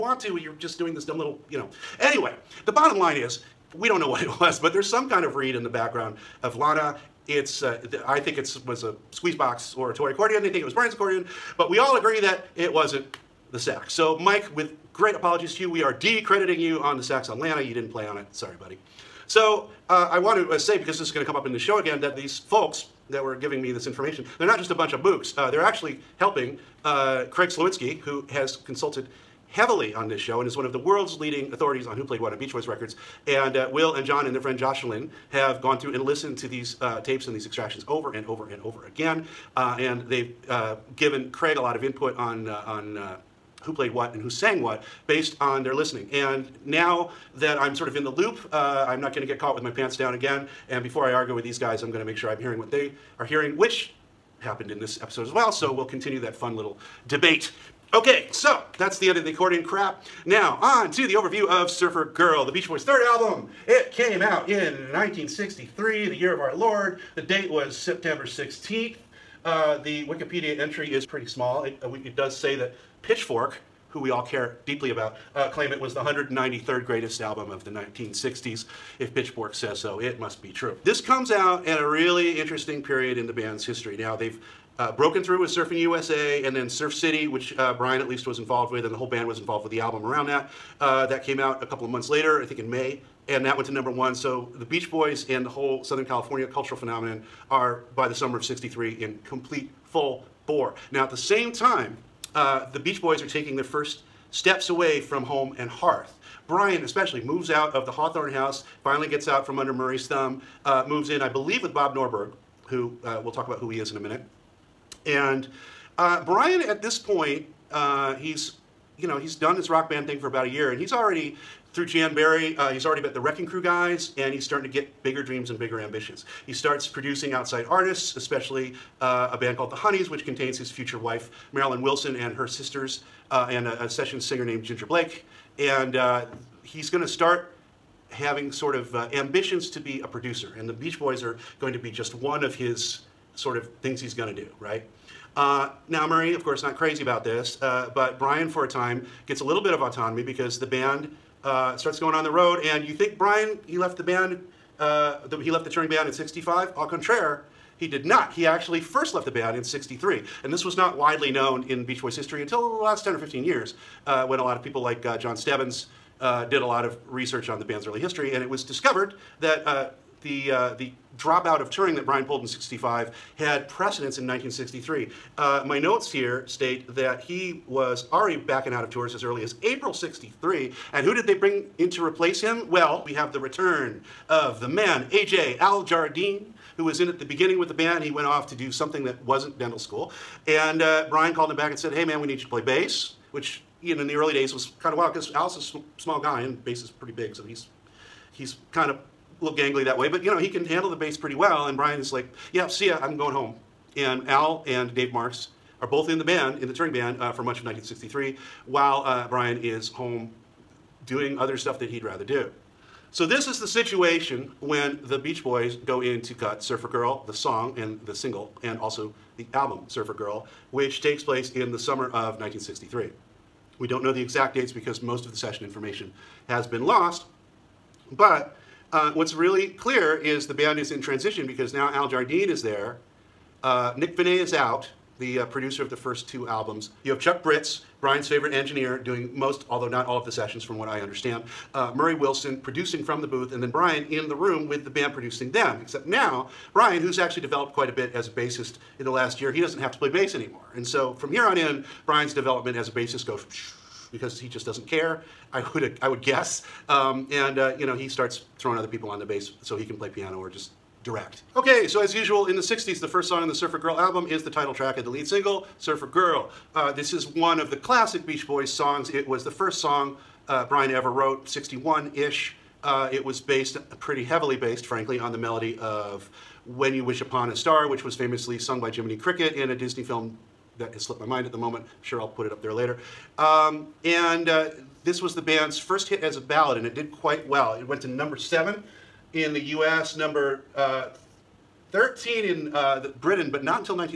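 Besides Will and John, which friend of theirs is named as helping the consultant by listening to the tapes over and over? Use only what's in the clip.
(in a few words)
Jocelyn.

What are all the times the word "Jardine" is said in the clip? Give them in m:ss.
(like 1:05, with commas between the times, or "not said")
3:05, 3:52.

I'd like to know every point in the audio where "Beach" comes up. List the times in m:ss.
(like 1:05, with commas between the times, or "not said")
0:32, 1:02, 1:34, 1:42, 2:20, 2:41, 3:35, 4:28.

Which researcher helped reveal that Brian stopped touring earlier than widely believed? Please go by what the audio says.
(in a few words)
Jon Stebbins.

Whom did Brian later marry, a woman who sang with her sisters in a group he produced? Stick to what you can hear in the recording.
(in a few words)
Marilyn Wilson.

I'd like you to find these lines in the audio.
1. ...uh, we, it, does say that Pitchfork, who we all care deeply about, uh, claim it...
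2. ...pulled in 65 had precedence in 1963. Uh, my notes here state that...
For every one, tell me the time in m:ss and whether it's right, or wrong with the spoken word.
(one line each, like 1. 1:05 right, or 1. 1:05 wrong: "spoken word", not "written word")
1. 1:11 right
2. 2:52 right.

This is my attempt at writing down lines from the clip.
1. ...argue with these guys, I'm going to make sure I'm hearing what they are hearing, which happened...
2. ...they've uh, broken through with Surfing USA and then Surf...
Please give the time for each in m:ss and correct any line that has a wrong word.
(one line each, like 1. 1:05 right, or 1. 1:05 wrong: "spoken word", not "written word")
1. 0:51 right
2. 1:24 right.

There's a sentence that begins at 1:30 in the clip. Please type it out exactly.
Uh, that came out a couple of months later, I think in May, and that went to number one.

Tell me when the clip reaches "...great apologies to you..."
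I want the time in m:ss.
0:14.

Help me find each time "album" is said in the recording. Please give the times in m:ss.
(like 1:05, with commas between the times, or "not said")
1:03, 1:17, 1:29, 3:39, 3:56, 4:23.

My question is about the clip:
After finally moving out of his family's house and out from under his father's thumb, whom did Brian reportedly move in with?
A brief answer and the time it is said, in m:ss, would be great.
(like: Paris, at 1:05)
Bob Norberg, at 1:51.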